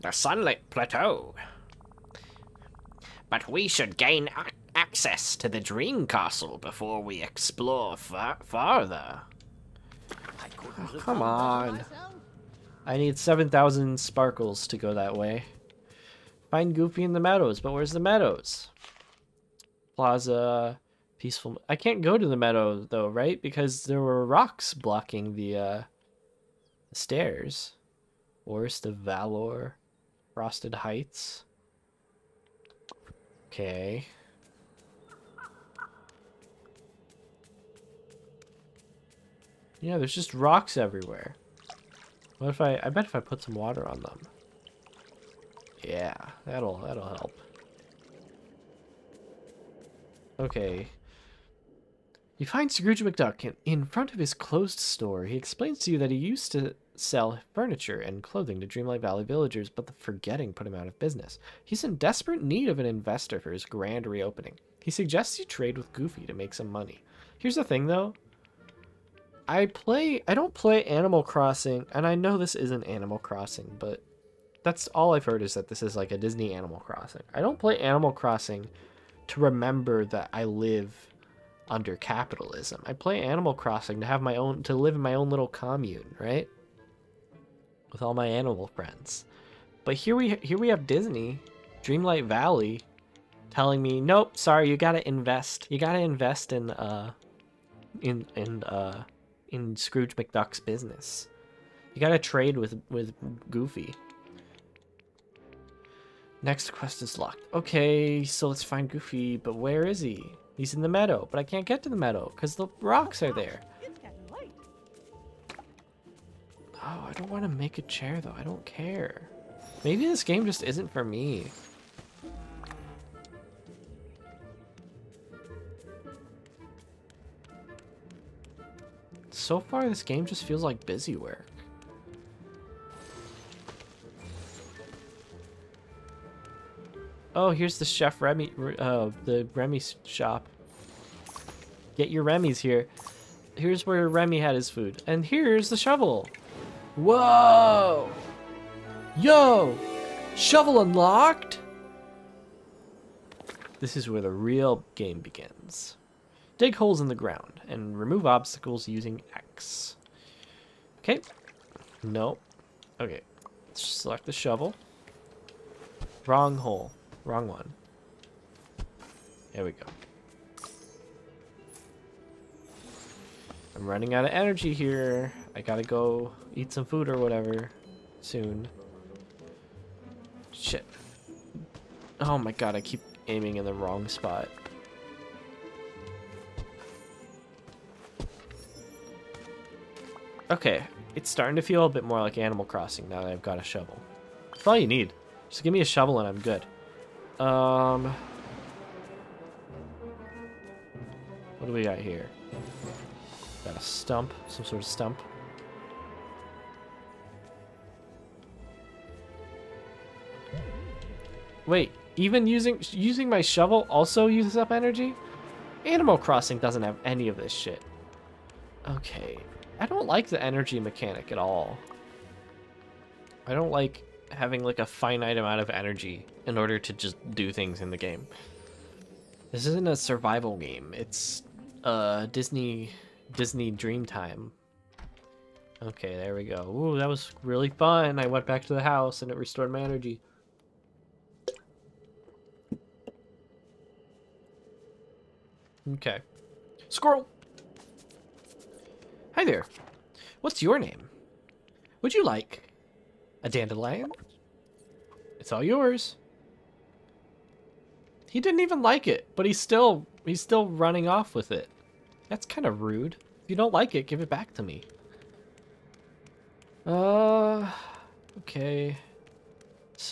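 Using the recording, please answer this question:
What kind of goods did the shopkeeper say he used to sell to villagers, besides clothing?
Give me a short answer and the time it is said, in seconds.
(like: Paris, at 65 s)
Furniture, at 57 s.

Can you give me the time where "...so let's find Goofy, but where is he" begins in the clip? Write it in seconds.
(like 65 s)
108 s.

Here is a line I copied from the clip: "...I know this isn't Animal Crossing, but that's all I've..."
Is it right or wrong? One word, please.
right.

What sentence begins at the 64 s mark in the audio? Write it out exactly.
He suggests you trade with Goofy to make some money.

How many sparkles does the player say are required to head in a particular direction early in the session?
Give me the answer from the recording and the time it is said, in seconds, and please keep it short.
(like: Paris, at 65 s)
7,000, at 13 s.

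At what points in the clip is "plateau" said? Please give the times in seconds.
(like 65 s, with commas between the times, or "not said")
0 s.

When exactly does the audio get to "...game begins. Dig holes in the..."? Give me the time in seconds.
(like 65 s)
154 s.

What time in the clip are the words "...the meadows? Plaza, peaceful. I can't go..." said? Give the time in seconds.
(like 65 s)
17 s.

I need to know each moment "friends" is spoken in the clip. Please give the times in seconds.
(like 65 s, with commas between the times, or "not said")
88 s.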